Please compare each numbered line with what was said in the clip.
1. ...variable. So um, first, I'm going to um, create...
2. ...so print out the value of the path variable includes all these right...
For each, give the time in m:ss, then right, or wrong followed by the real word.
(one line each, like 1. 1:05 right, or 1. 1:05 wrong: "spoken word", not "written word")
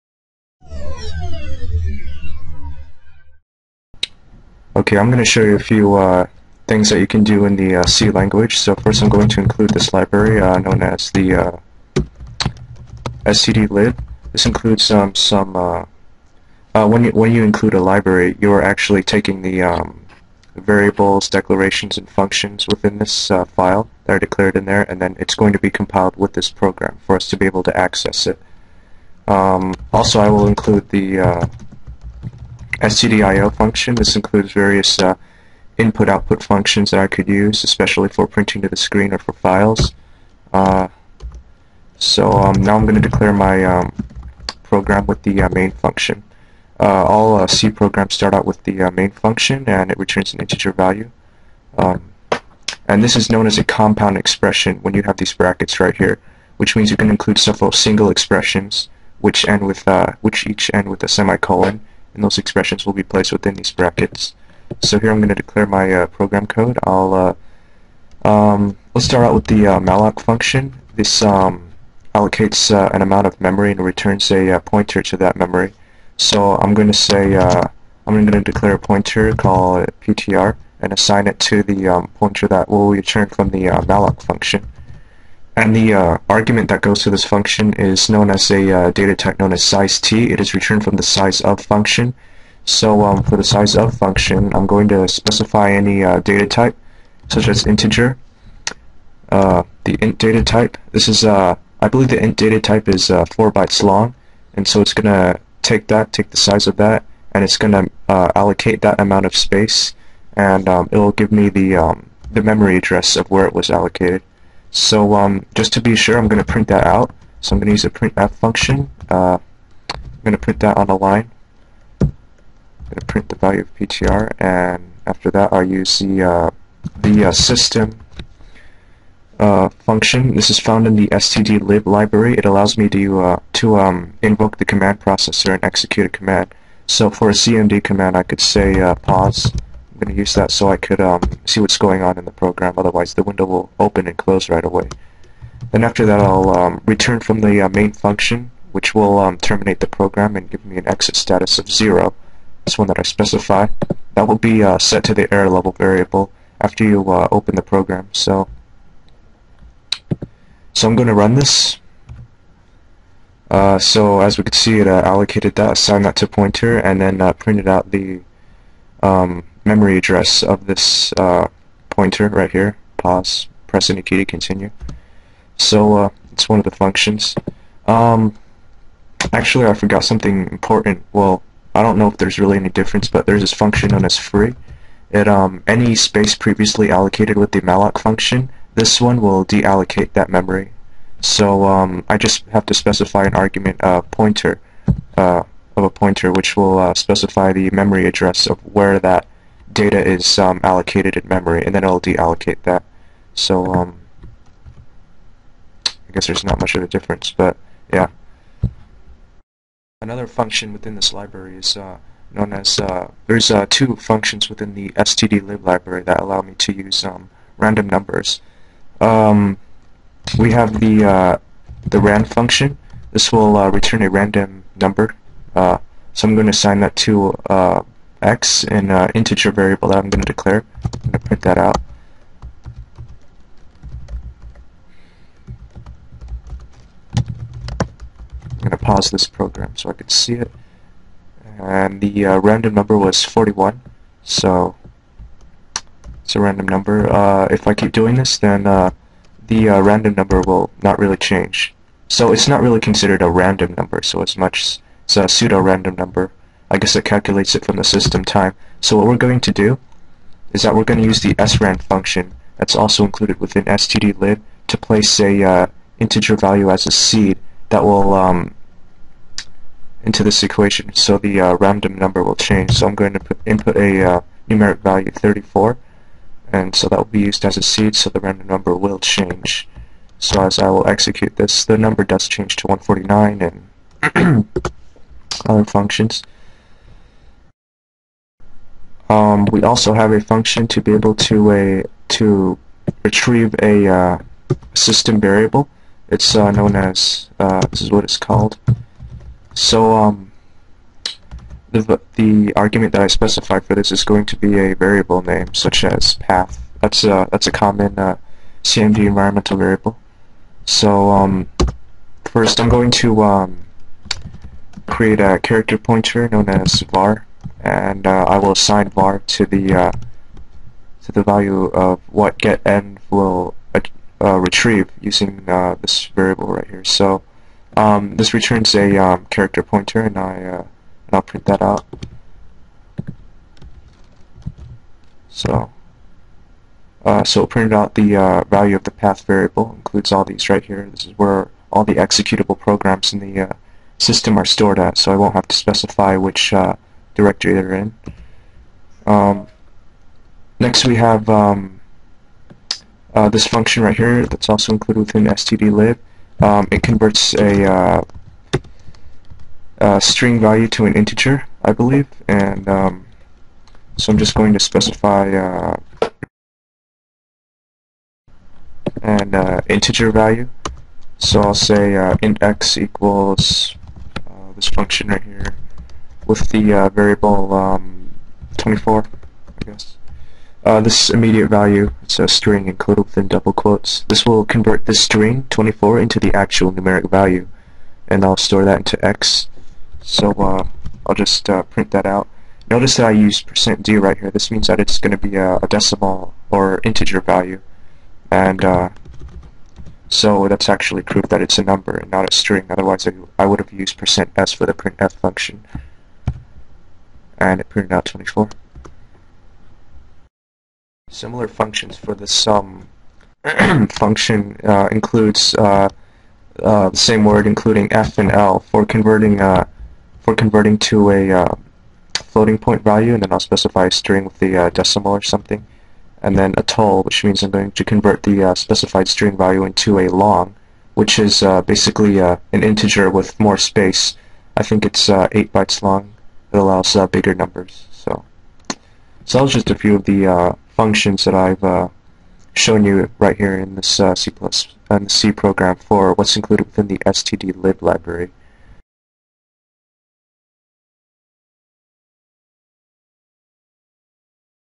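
1. 5:09 right
2. 5:37 right.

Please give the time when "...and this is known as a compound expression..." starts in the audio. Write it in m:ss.
0:52.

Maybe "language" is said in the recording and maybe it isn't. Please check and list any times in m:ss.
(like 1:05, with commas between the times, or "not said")
0:08.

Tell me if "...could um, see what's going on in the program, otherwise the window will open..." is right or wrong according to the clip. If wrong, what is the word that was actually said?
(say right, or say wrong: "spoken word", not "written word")
right.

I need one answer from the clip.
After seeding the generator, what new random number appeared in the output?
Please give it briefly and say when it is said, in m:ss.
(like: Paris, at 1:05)
149, at 4:42.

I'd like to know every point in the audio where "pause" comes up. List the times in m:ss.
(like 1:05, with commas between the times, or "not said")
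2:18, 2:52, 3:58.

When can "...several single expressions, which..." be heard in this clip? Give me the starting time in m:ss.
0:57.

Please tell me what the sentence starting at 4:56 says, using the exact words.
It's uh, known as uh, this is what it's called.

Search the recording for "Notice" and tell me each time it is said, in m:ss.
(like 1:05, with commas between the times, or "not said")
6:32.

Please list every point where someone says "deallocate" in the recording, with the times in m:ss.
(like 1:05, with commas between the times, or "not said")
3:09, 3:22.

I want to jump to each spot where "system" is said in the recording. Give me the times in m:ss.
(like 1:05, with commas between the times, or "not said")
2:07, 4:17, 4:54, 5:43.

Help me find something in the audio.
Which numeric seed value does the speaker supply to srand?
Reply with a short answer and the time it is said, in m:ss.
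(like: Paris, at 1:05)
34, at 4:35.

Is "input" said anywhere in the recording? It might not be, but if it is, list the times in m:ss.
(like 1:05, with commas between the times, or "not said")
0:35, 4:33.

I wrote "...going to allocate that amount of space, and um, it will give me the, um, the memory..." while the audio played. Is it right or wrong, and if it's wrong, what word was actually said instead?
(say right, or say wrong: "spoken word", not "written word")
right.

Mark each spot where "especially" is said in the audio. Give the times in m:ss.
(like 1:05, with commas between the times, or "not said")
0:37.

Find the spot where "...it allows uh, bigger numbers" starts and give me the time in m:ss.
7:16.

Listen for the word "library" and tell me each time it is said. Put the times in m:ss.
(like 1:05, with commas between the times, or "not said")
0:09, 0:17, 2:11, 3:31, 3:35, 7:27.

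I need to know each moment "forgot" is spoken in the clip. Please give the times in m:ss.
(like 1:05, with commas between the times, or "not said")
2:59.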